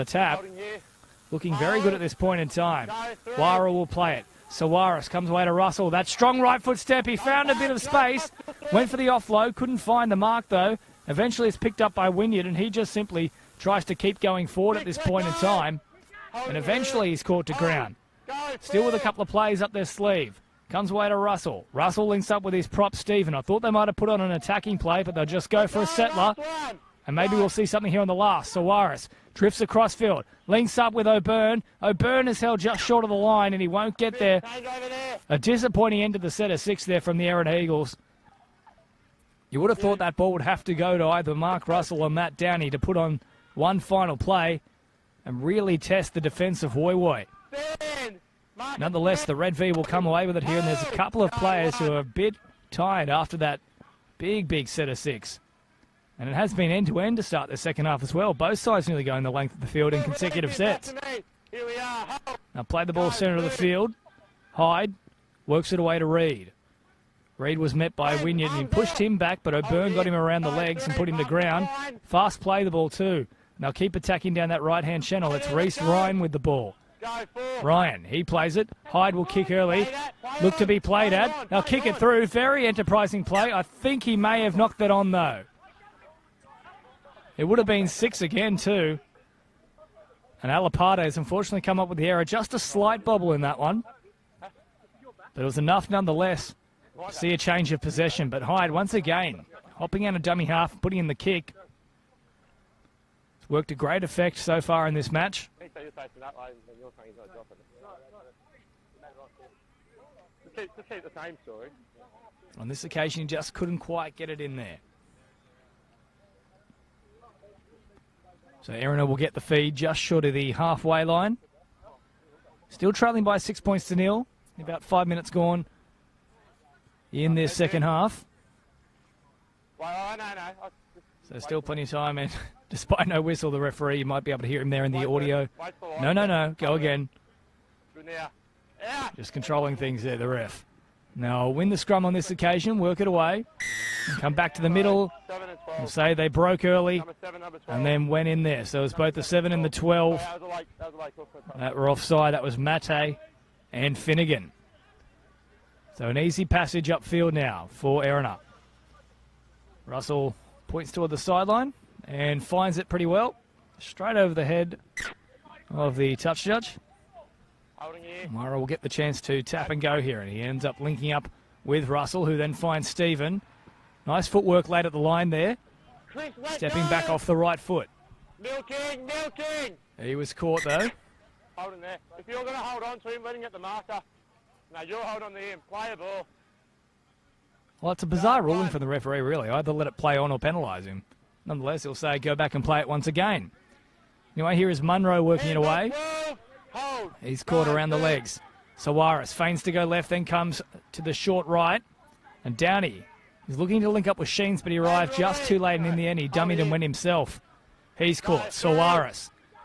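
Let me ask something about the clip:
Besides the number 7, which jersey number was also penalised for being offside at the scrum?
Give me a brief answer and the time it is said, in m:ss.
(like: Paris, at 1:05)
12, at 2:29.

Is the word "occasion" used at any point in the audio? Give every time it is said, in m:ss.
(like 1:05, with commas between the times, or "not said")
1:52, 2:22.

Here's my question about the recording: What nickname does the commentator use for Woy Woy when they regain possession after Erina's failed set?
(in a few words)
Red V.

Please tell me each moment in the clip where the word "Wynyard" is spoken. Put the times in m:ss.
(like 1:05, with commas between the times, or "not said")
0:12, 1:08.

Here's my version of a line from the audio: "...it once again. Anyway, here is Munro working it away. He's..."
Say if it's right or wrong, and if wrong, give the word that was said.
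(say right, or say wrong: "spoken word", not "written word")
right.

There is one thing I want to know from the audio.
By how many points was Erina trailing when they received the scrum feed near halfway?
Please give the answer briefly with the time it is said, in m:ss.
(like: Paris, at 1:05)
6, at 2:03.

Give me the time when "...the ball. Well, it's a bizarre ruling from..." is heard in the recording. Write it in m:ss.
3:05.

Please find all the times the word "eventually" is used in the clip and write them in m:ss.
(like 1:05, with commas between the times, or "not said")
0:11, 0:16.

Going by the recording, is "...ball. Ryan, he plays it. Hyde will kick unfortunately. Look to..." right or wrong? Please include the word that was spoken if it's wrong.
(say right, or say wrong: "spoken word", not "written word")
wrong: "early", not "unfortunately".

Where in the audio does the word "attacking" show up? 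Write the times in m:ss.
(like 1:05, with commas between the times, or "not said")
0:24, 1:13.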